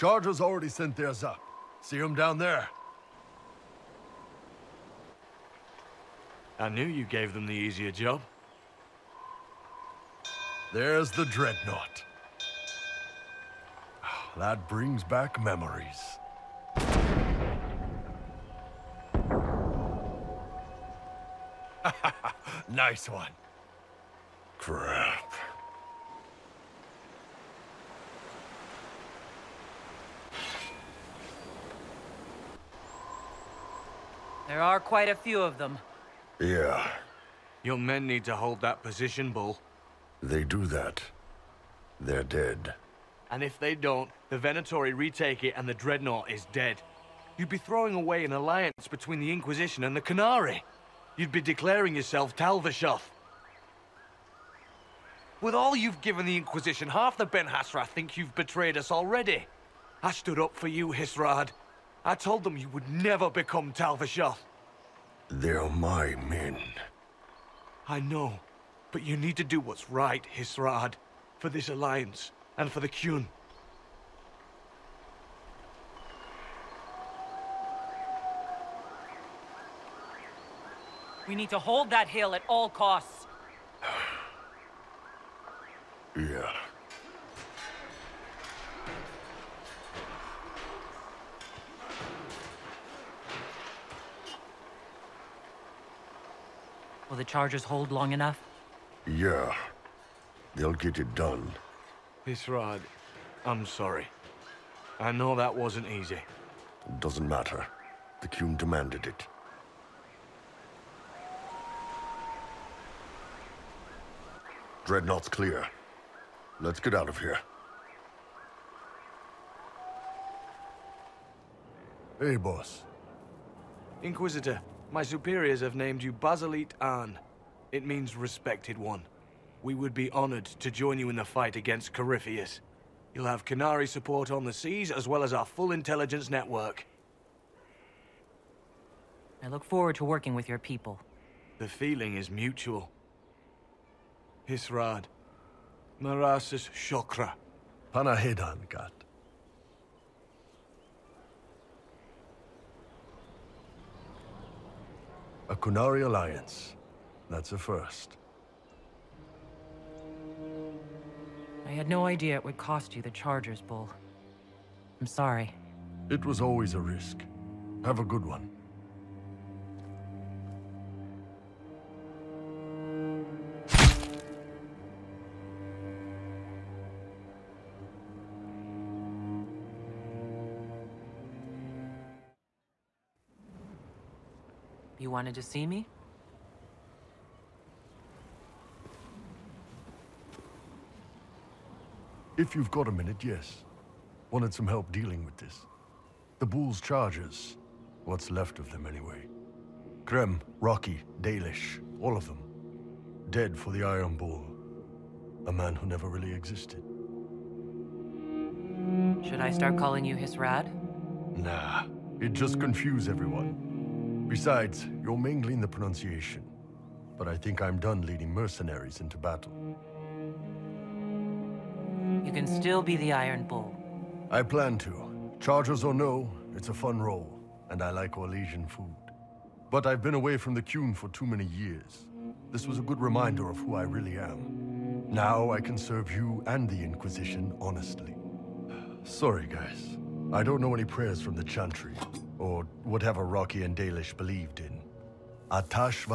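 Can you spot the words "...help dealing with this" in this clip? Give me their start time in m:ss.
3:14.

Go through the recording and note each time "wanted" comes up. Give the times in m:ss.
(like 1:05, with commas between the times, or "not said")
3:05, 3:14.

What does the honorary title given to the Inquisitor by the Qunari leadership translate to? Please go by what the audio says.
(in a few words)
Respected one.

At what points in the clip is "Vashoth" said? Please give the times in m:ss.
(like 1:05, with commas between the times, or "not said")
0:52, 1:03.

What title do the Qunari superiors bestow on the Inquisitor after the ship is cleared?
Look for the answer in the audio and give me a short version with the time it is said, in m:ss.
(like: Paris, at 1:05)
Basilit An, at 2:06.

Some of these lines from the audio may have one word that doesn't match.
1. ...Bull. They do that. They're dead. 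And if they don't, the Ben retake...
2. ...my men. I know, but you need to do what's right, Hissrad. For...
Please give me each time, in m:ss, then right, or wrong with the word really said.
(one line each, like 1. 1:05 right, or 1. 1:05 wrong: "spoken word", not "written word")
1. 0:39 wrong: "Venatori", not "Ben"
2. 1:05 right.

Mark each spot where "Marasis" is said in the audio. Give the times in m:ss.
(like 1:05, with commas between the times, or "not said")
2:26.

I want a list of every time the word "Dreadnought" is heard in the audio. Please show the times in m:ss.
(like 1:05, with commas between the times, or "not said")
0:11, 0:45, 1:54.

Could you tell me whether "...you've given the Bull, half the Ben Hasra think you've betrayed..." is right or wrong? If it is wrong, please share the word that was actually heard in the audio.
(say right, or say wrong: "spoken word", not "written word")
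wrong: "Inquisition", not "Bull".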